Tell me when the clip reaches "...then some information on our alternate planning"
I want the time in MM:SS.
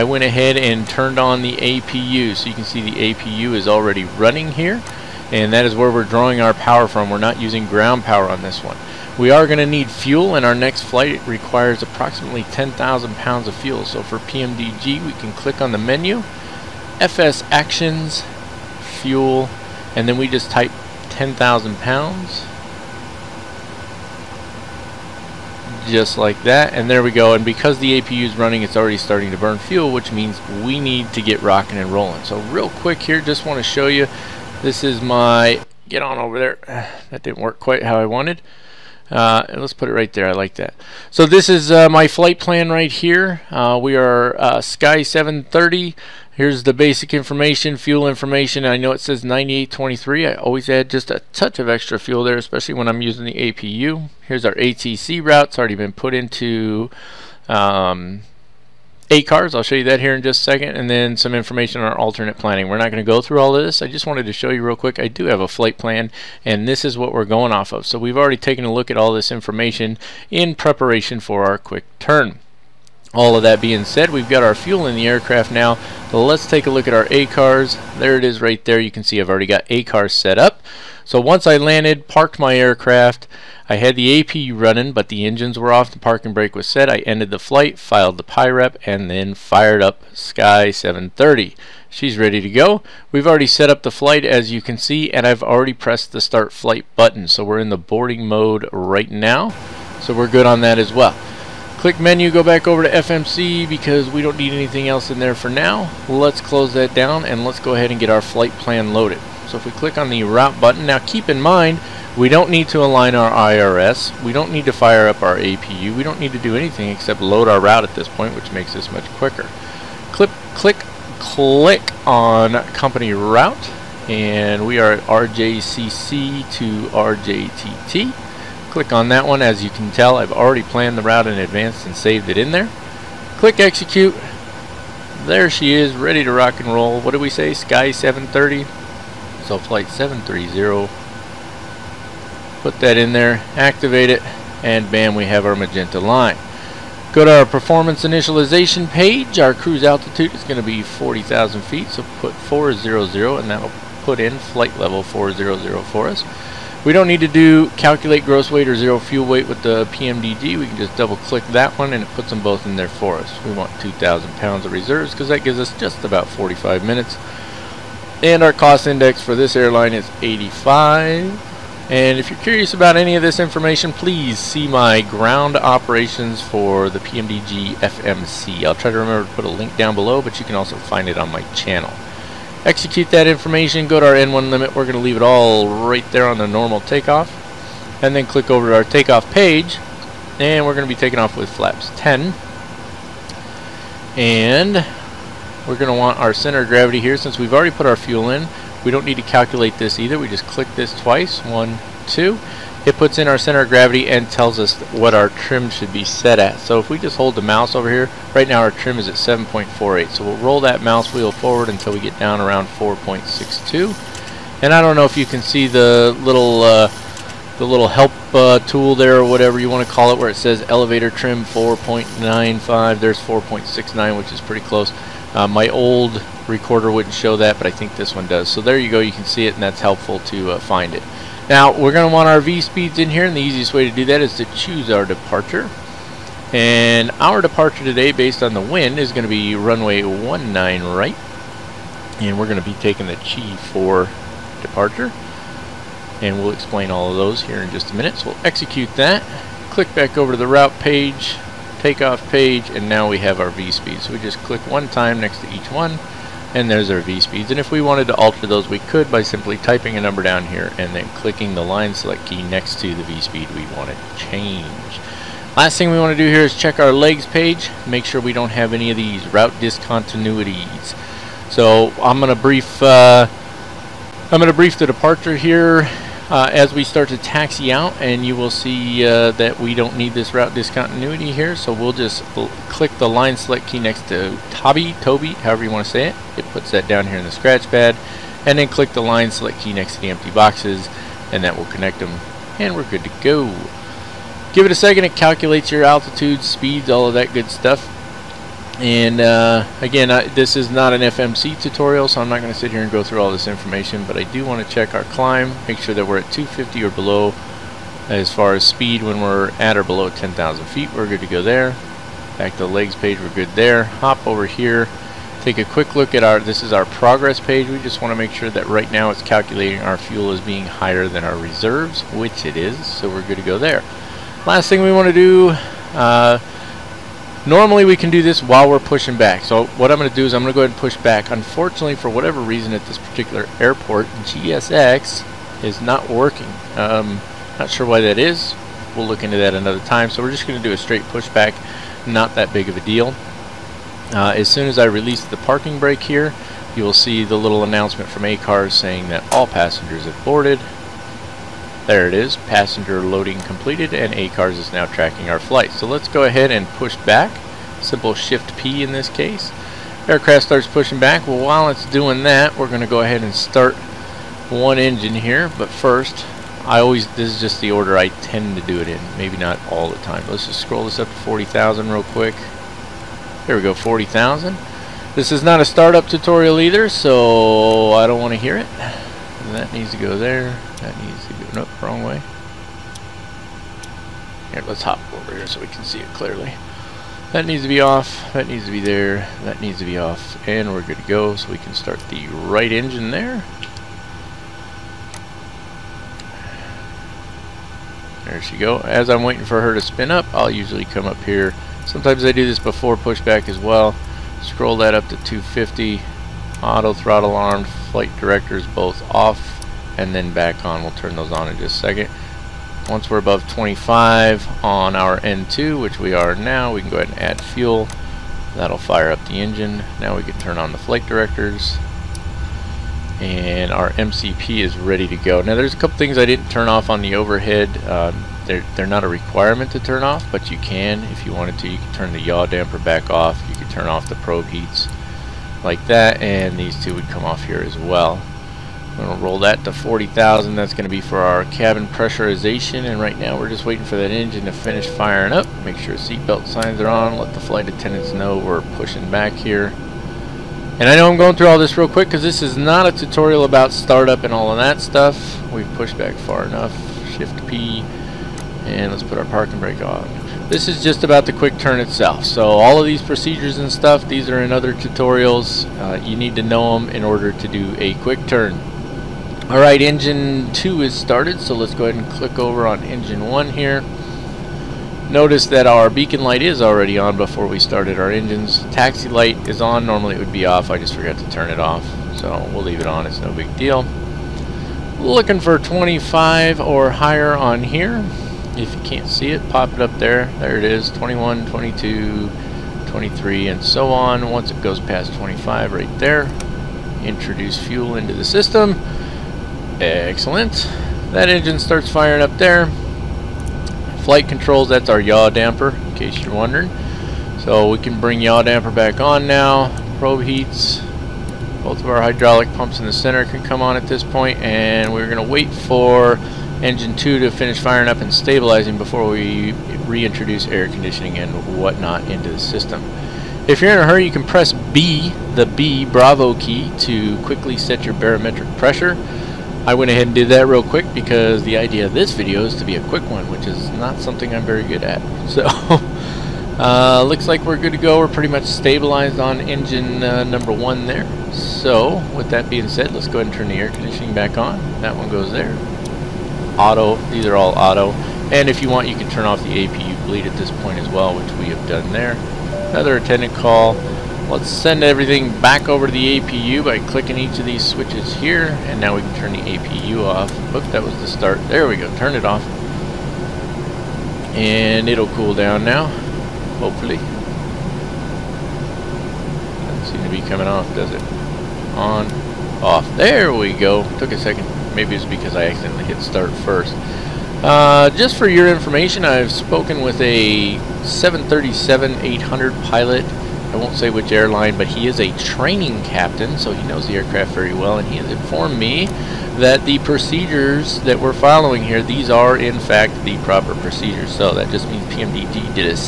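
01:00.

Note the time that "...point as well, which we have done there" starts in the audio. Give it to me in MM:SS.
09:10.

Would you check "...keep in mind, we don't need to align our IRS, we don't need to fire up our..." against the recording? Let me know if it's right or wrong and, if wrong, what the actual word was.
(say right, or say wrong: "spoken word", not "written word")
right.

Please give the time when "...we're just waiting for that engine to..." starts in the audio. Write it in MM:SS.
07:23.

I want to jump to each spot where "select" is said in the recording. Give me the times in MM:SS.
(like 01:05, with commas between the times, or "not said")
04:21, 04:43, 04:49.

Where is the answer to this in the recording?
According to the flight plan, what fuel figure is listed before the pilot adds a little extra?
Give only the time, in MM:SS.
00:49.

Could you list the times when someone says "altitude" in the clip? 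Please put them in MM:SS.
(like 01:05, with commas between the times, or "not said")
02:29, 04:55.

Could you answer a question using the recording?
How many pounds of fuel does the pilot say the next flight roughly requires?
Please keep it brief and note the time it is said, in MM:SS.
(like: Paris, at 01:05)
10,000 pounds, at 00:11.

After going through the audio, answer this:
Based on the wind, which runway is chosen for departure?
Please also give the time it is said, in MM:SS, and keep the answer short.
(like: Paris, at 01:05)
Runway 19 right, at 03:59.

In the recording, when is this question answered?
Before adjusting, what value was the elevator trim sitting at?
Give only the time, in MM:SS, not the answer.
03:29.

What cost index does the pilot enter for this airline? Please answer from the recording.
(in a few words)
85.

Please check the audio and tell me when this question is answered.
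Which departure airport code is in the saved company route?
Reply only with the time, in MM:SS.
02:05.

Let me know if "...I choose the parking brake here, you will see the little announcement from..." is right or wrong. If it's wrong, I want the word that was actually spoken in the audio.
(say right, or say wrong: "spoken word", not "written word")
wrong: "release", not "choose".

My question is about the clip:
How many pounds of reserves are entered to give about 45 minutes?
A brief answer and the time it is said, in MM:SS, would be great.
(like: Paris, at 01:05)
2,000 pounds, at 02:43.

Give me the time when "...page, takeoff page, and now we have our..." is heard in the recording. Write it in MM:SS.
04:10.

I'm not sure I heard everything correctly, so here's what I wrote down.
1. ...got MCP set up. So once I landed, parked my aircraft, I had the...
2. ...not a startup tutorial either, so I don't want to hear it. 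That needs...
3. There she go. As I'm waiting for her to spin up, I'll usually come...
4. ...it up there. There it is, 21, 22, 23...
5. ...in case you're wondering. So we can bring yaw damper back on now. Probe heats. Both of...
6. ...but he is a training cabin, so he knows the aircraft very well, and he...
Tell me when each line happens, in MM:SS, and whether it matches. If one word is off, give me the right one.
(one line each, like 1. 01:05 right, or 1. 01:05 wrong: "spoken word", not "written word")
1. 01:19 wrong: "ACARS", not "MCP"
2. 06:15 right
3. 06:38 right
4. 08:09 right
5. 08:25 right
6. 09:44 wrong: "captain", not "cabin".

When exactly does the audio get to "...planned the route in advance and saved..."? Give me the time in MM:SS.
02:10.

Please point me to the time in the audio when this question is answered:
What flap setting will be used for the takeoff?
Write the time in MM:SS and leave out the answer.
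03:11.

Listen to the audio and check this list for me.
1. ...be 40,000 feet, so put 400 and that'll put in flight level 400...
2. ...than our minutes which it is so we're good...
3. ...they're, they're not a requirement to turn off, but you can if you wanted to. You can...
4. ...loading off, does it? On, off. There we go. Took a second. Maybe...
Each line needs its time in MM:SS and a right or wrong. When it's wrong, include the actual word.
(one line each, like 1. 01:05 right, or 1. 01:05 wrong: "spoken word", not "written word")
1. 02:30 right
2. 05:21 wrong: "reserves", not "minutes"
3. 07:08 right
4. 09:30 wrong: "coming", not "loading".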